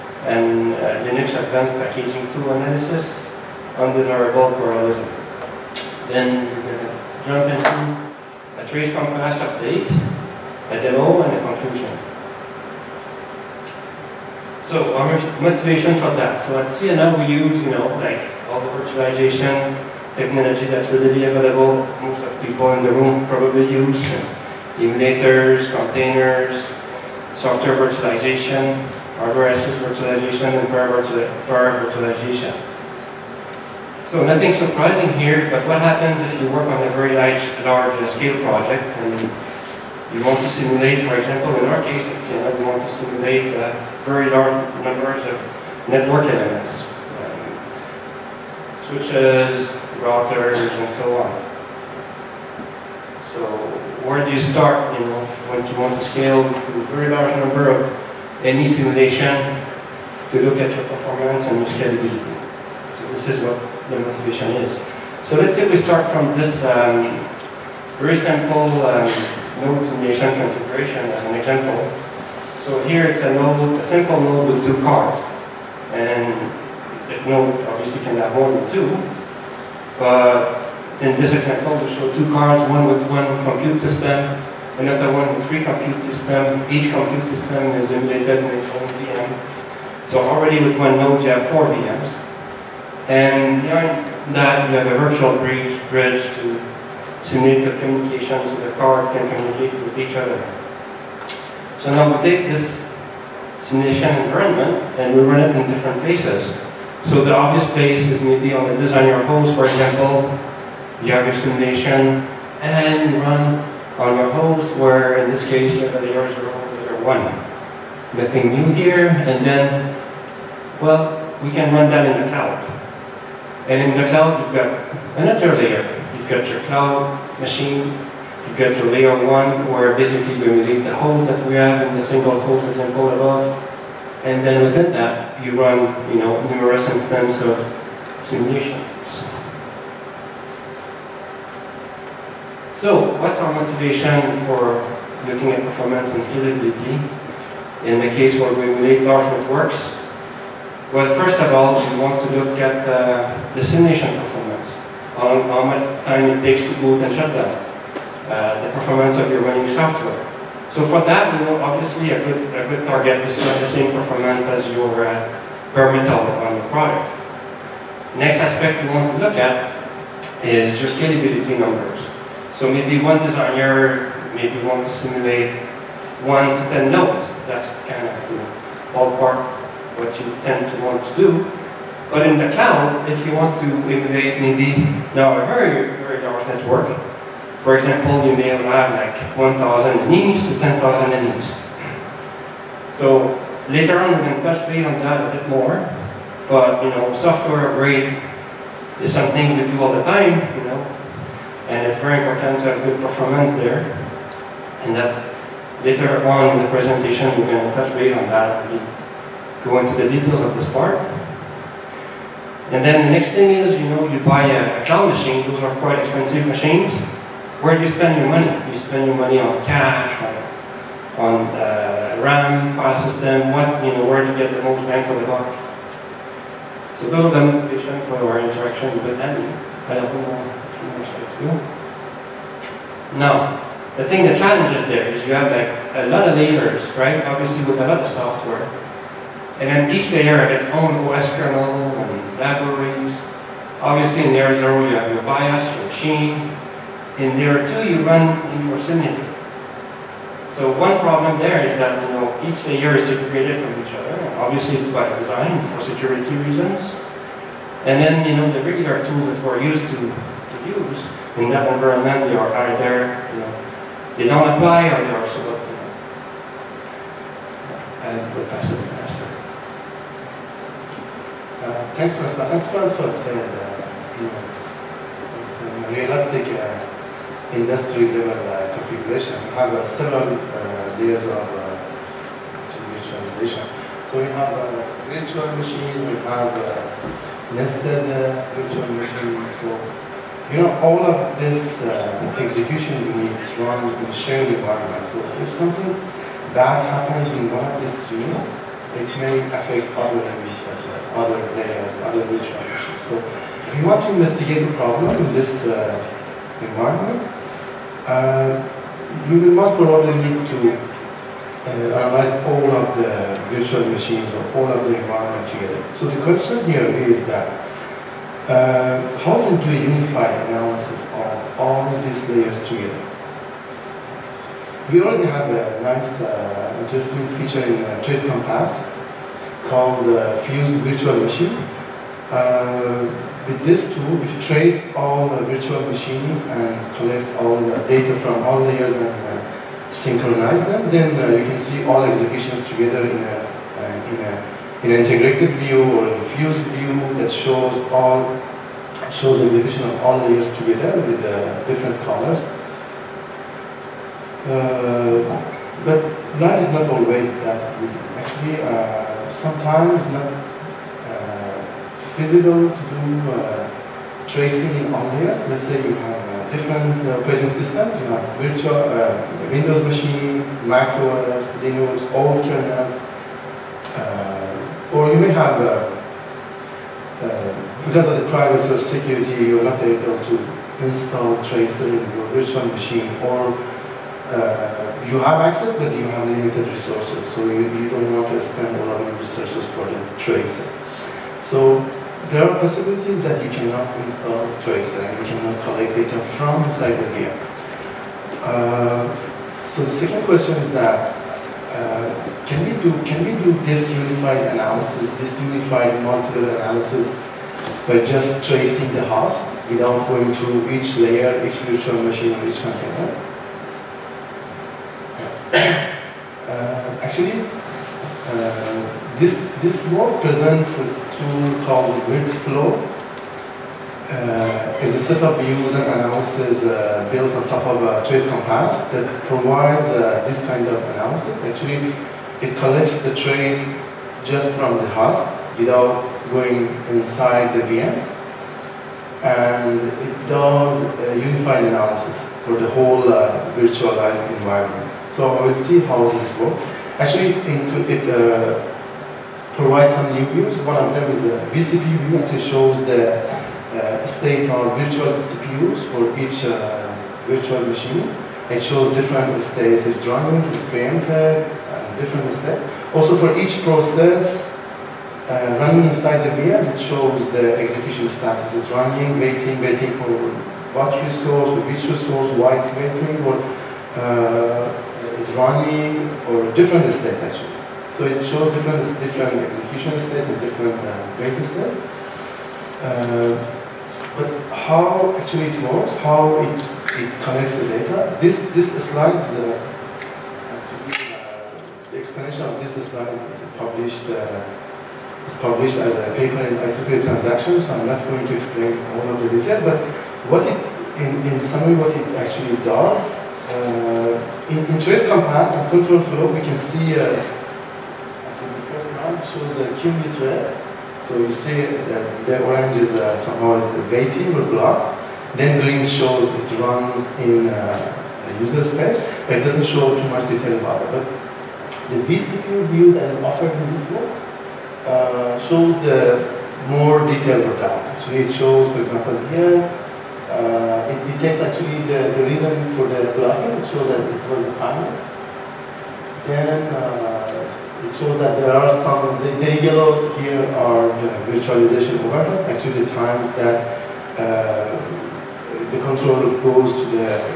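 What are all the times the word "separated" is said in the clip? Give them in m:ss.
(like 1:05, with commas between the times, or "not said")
4:13.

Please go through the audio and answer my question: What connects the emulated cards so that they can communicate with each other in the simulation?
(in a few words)
A virtual bridge.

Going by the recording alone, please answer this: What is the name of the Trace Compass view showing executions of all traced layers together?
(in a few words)
Fused virtual machine.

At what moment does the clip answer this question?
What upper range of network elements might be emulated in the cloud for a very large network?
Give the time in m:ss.
3:10.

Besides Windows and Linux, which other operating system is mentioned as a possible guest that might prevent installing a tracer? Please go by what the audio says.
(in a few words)
Mac OS.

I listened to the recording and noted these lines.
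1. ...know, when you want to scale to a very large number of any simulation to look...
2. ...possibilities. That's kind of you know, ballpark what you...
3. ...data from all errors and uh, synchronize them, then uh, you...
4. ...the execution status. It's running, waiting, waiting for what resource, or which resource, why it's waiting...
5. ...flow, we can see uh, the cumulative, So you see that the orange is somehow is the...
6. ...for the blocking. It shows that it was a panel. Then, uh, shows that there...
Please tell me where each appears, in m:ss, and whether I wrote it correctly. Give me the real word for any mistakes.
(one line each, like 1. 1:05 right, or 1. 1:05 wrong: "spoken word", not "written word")
1. 0:55 right
2. 2:56 wrong: "nodes", not "possibilities"
3. 5:37 wrong: "layers", not "errors"
4. 7:47 right
5. 8:25 right
6. 8:52 right.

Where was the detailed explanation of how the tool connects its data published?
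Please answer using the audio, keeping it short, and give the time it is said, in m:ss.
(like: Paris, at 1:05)
IEEE Transactions, at 8:16.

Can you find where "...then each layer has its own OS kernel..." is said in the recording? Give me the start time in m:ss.
3:59.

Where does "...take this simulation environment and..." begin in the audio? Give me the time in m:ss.
1:42.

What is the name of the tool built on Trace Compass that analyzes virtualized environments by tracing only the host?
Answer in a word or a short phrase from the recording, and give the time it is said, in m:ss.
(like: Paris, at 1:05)
Grid flow, at 7:02.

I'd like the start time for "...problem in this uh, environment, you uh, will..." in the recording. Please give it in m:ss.
5:04.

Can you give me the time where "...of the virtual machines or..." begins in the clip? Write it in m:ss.
5:12.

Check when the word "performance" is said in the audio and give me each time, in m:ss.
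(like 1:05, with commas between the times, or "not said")
1:00, 2:25, 2:38, 2:43, 3:23.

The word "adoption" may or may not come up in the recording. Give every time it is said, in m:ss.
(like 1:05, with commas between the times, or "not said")
not said.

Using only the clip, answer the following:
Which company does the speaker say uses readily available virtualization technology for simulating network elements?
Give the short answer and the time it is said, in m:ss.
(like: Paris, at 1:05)
Ciena, at 0:16.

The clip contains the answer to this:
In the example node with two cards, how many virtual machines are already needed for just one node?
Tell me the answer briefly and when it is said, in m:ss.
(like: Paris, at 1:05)
4, at 1:31.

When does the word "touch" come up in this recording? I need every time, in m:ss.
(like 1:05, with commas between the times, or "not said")
3:14, 3:27.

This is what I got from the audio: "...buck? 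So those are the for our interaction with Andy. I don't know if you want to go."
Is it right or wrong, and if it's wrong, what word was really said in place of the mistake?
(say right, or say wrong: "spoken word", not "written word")
right.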